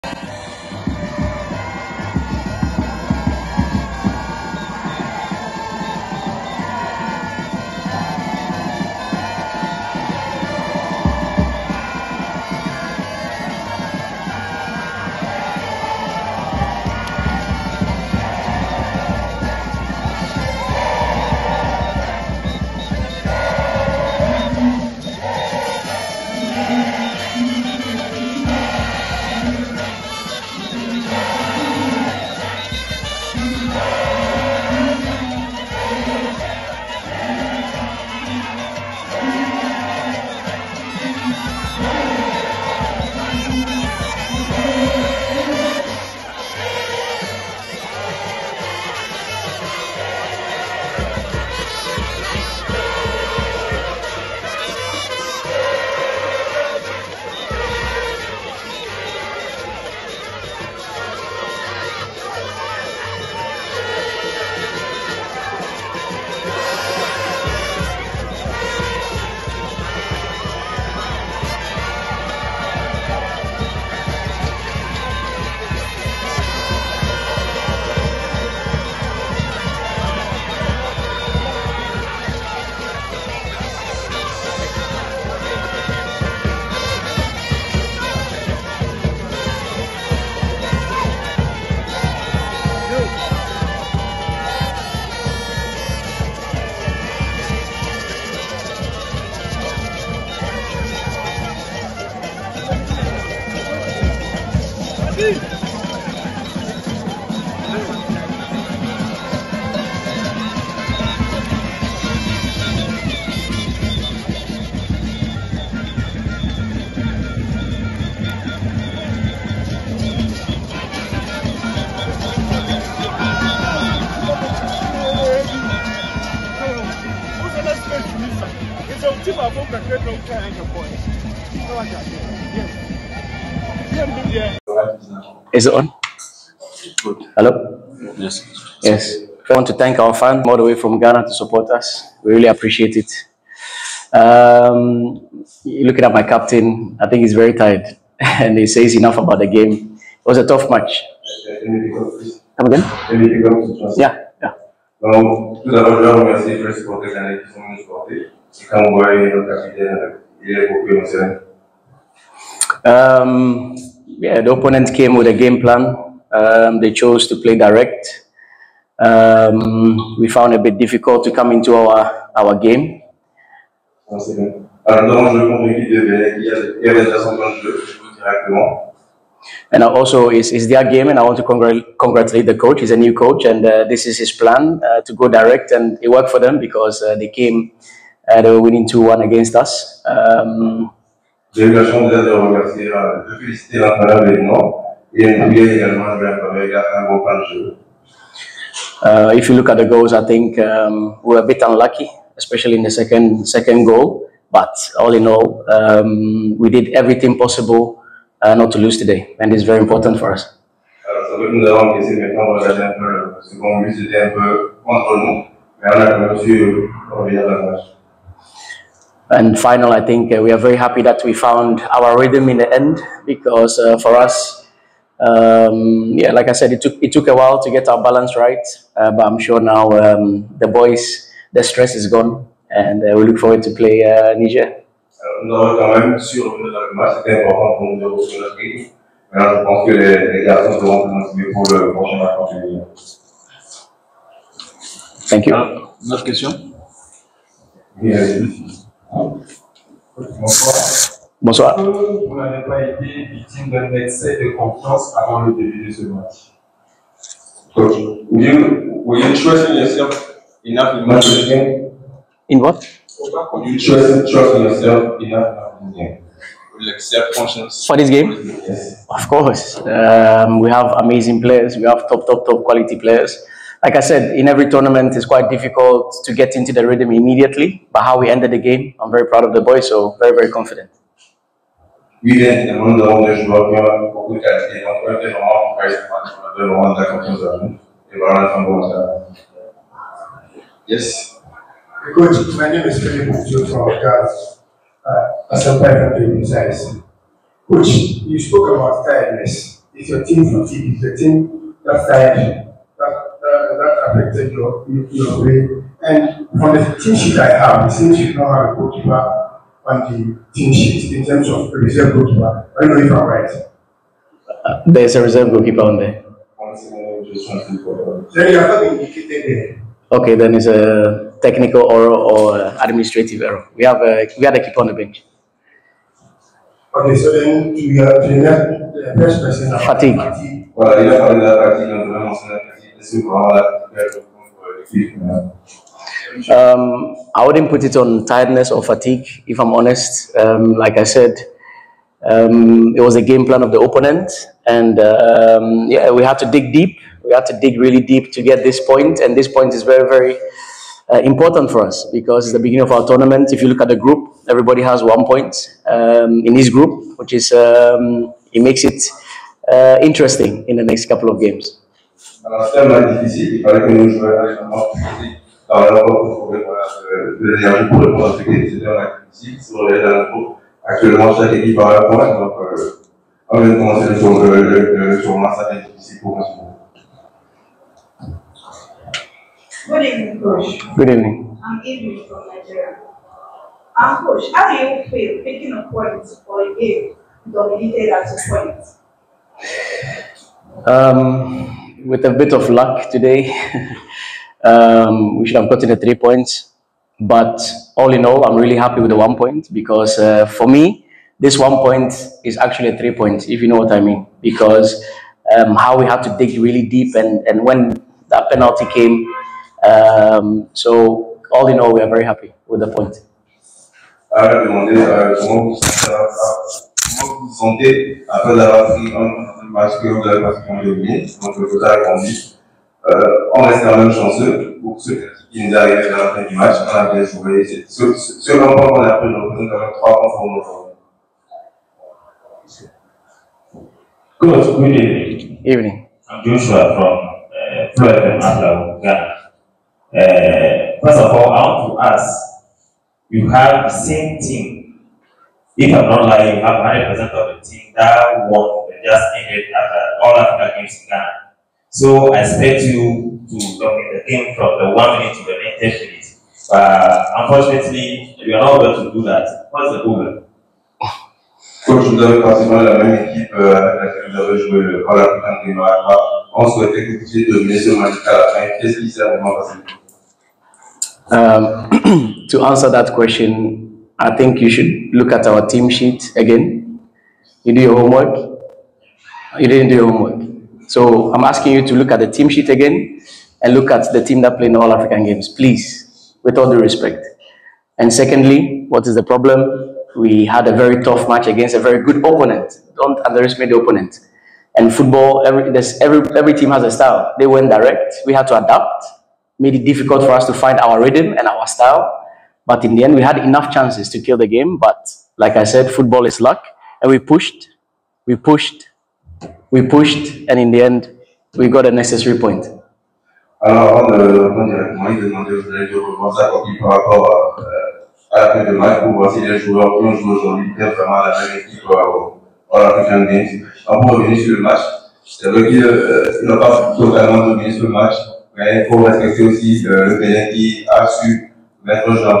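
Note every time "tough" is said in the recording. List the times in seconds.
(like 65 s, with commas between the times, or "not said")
150 s, 491 s.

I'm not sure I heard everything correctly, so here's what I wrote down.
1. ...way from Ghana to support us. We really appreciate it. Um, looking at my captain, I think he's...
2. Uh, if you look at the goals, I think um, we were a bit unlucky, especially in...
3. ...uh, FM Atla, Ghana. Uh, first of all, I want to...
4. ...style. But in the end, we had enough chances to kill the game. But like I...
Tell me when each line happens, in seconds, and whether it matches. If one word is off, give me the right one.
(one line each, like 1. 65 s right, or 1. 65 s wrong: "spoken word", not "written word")
1. 140 s right
2. 199 s right
3. 437 s right
4. 501 s right.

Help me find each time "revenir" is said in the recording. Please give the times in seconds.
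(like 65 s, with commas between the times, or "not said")
523 s.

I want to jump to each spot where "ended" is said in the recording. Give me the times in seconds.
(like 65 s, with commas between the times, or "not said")
278 s, 449 s.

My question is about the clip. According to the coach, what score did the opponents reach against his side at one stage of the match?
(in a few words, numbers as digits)
2-1.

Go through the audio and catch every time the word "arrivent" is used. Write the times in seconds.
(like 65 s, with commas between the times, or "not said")
425 s.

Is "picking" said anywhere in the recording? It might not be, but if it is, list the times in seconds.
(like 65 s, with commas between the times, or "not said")
385 s.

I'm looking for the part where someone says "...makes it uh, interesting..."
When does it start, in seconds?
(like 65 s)
358 s.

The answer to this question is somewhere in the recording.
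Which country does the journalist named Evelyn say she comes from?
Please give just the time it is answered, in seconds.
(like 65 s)
382 s.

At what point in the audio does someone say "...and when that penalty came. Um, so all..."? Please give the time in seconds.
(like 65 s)
407 s.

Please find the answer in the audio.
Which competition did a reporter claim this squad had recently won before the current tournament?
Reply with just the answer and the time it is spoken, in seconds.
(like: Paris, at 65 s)
All African Games, at 450 s.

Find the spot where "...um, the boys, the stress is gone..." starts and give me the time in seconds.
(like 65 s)
229 s.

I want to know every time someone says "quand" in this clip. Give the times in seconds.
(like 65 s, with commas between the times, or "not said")
423 s, 429 s.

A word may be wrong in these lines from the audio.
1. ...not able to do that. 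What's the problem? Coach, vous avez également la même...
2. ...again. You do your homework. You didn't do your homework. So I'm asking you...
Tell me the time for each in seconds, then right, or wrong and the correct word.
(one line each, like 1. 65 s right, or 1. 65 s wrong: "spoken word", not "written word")
1. 458 s wrong: "pratiquement", not "également"
2. 476 s right.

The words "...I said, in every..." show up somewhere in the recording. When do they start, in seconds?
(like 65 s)
273 s.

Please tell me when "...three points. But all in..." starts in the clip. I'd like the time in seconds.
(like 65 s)
395 s.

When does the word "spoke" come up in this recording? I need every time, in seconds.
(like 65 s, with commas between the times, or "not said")
298 s.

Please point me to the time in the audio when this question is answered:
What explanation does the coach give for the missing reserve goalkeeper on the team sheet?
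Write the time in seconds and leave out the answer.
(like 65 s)
322 s.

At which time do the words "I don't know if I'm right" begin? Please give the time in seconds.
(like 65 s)
312 s.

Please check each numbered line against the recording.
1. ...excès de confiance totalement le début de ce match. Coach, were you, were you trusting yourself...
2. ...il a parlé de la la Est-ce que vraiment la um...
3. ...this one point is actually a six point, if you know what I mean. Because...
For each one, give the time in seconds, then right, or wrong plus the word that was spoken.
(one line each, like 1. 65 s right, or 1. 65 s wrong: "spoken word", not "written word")
1. 253 s wrong: "avant", not "totalement"
2. 330 s right
3. 401 s wrong: "three", not "six".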